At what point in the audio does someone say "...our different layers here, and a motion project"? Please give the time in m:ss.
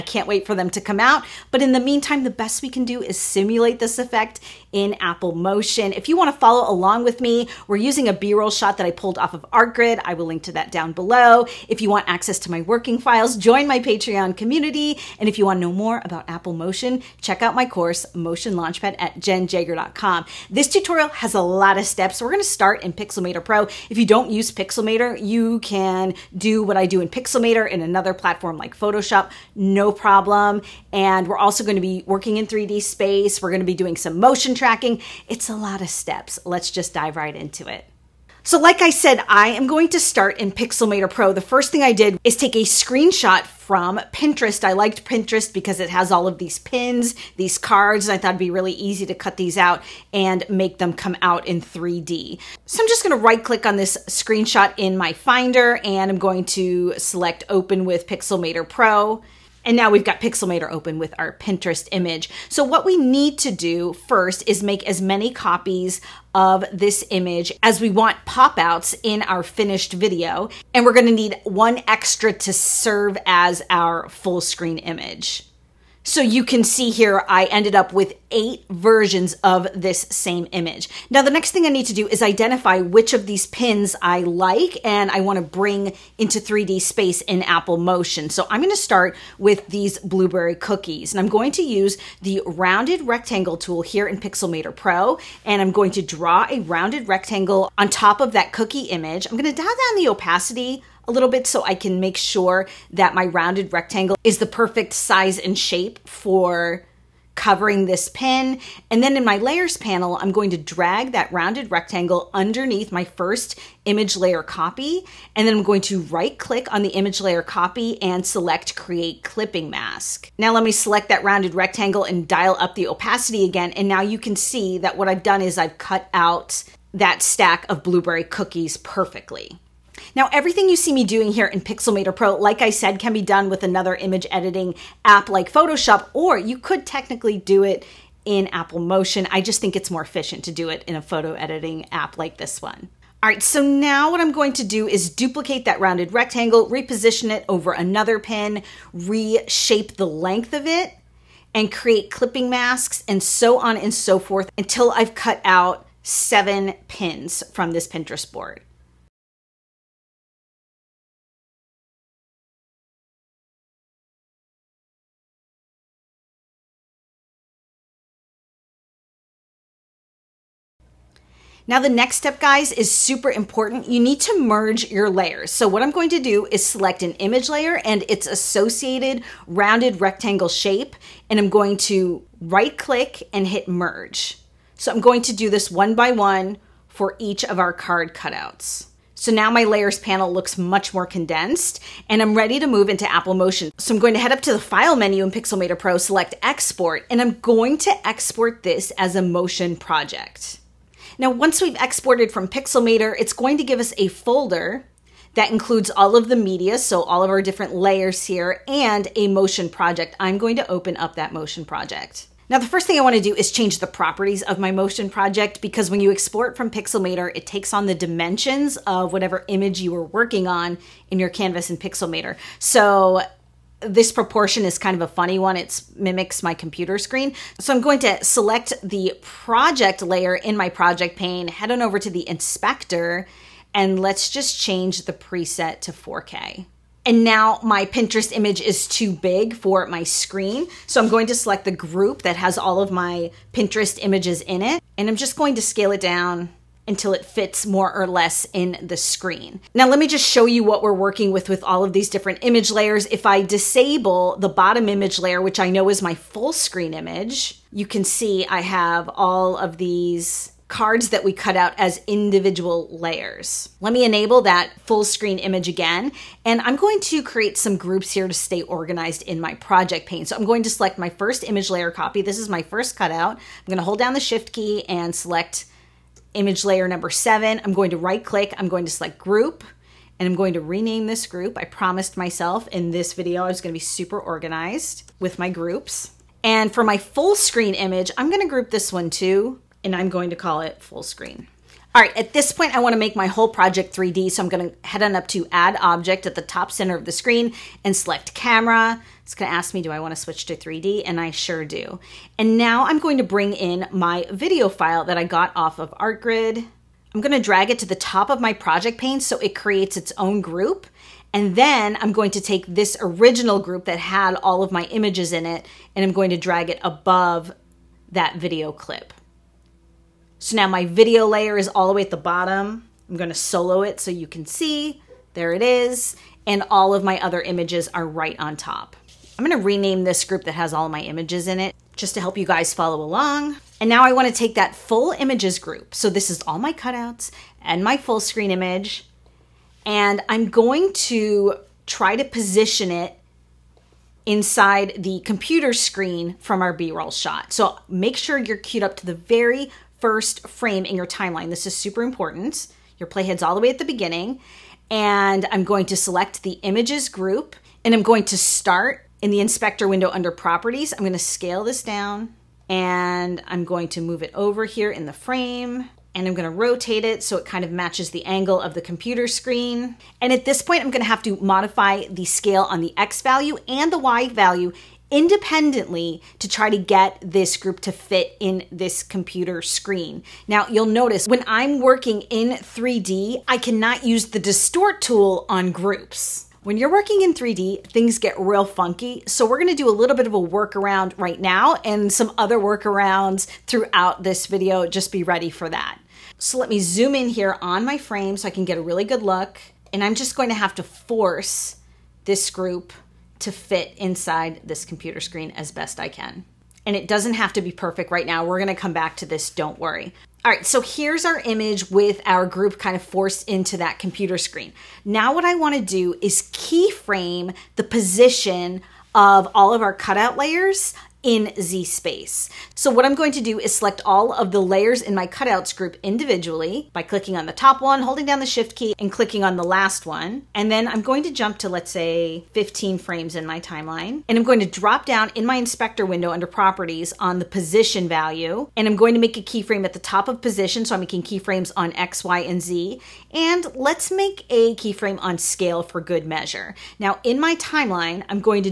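3:27.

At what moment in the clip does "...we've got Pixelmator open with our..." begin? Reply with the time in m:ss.
0:59.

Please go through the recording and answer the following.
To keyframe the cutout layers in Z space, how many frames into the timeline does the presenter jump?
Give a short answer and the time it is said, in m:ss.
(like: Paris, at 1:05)
15, at 7:12.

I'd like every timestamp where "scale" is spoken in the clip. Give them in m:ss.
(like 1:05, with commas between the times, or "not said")
4:05, 6:01, 6:12, 7:25.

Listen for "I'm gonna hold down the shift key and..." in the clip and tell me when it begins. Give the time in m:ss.
4:33.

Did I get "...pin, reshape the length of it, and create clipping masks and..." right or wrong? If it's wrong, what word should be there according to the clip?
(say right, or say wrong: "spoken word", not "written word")
right.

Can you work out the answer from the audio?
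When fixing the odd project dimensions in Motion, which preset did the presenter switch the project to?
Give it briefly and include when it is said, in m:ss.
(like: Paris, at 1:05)
4K, at 3:55.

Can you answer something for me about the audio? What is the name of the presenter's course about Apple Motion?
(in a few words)
Motion Launchpad.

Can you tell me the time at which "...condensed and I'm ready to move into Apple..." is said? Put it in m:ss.
3:11.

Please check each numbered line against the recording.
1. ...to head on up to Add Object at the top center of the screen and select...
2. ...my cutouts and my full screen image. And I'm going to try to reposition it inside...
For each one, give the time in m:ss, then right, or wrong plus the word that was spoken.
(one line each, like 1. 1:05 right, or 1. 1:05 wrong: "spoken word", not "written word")
1. 4:54 right
2. 5:36 wrong: "position", not "reposition".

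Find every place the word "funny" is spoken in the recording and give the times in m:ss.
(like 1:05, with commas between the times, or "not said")
3:45.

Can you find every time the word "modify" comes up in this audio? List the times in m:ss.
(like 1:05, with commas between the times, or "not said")
6:11.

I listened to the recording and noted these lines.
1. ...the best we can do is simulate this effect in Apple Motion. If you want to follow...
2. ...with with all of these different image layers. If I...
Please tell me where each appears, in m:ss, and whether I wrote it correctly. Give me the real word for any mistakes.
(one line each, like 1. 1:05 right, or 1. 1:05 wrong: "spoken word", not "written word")
1. 0:02 right
2. 4:11 right.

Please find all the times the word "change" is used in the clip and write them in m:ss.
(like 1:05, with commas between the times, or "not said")
3:33, 3:54.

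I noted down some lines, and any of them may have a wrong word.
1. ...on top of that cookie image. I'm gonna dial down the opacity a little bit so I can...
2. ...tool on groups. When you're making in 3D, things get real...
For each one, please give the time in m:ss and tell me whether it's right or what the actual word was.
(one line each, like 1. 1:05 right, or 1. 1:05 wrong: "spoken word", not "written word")
1. 1:37 right
2. 6:25 wrong: "working", not "making".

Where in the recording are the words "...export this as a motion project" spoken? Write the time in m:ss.
3:18.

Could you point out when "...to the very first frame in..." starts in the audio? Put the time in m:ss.
5:48.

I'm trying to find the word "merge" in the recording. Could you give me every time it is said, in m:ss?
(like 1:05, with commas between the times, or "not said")
2:54, 3:03.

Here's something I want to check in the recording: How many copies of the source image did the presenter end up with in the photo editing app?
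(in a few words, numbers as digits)
8.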